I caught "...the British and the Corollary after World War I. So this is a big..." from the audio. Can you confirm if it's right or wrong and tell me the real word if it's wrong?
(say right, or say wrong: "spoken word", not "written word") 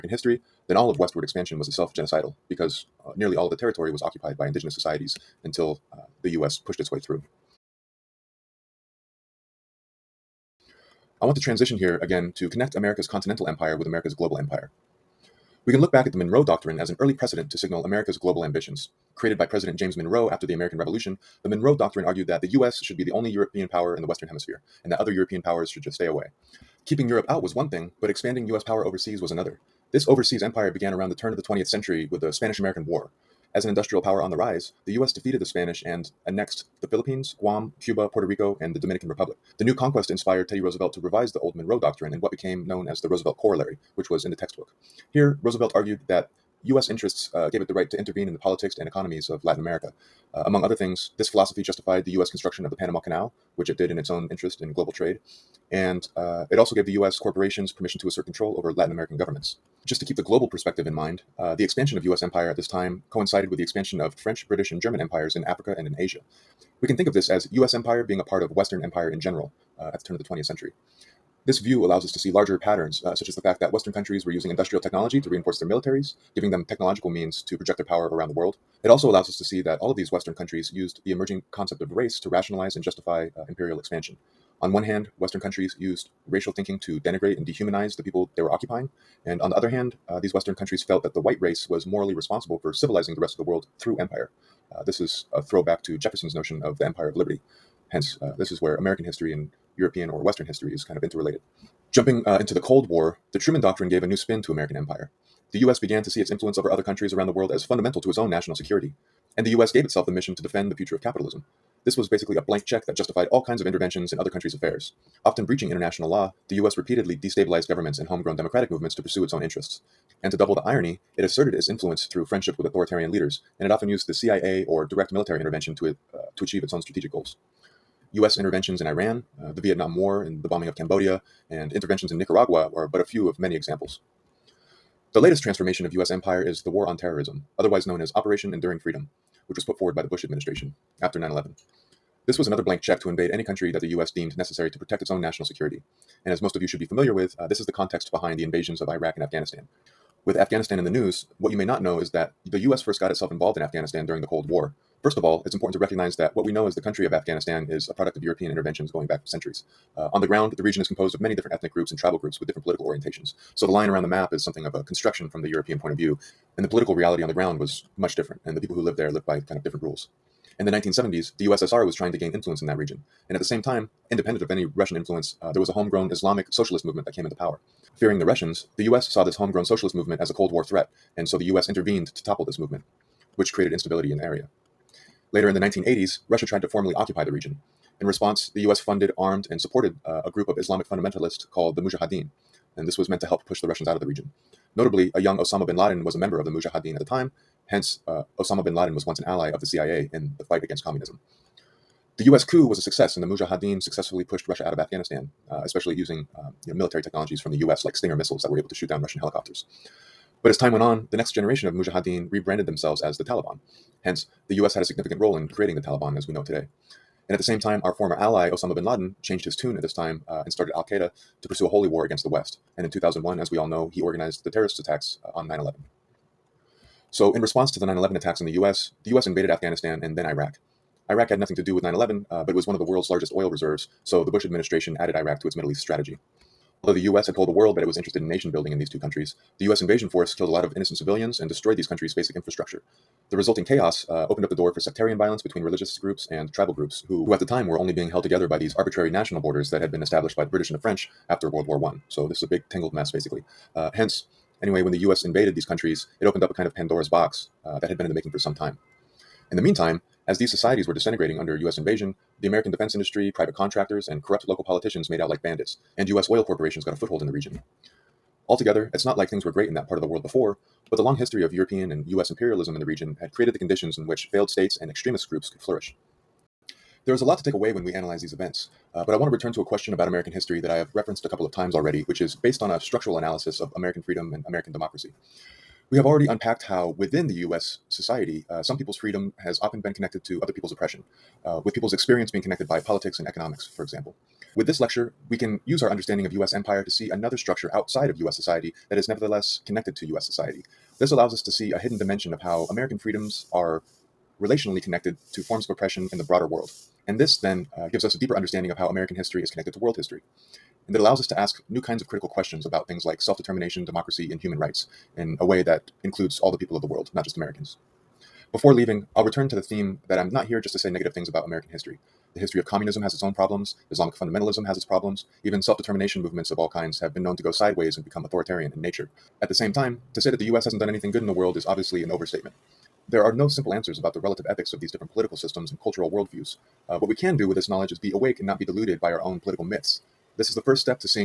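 wrong: "French", not "Corollary".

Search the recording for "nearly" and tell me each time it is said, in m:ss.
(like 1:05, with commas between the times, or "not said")
0:03.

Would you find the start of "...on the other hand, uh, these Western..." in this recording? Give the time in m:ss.
1:29.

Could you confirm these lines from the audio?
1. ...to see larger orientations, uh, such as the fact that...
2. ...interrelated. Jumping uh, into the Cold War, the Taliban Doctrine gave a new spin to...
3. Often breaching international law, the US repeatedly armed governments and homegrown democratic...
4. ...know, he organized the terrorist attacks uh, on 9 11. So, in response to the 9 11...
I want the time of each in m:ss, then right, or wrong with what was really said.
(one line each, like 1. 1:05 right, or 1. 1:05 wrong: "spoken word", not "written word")
1. 1:12 wrong: "patterns", not "orientations"
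2. 1:41 wrong: "Truman", not "Taliban"
3. 1:55 wrong: "destabilized", not "armed"
4. 3:43 right.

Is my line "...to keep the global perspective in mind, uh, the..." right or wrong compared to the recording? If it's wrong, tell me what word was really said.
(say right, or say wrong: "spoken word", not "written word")
right.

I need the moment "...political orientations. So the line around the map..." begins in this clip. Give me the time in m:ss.
2:42.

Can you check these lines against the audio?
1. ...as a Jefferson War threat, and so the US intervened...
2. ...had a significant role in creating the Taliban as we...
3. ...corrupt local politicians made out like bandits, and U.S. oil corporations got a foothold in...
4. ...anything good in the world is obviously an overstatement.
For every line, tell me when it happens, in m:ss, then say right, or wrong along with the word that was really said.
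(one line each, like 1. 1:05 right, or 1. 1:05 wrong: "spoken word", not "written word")
1. 3:00 wrong: "Cold", not "Jefferson"
2. 3:34 right
3. 4:24 right
4. 5:30 right.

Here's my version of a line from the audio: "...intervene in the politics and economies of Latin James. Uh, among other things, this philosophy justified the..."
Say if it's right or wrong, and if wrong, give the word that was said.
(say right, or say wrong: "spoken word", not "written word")
wrong: "America", not "James".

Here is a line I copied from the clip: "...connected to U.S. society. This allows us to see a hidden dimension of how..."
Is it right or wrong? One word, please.
right.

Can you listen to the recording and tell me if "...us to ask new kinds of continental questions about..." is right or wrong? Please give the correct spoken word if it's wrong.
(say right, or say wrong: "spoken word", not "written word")
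wrong: "critical", not "continental".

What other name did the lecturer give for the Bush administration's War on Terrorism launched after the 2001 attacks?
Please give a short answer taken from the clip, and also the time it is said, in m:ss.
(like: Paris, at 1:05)
Operation Enduring Freedom, at 2:18.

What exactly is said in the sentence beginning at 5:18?
Before leaving, I'll return to the theme that I'm not here just to say negative things about American history.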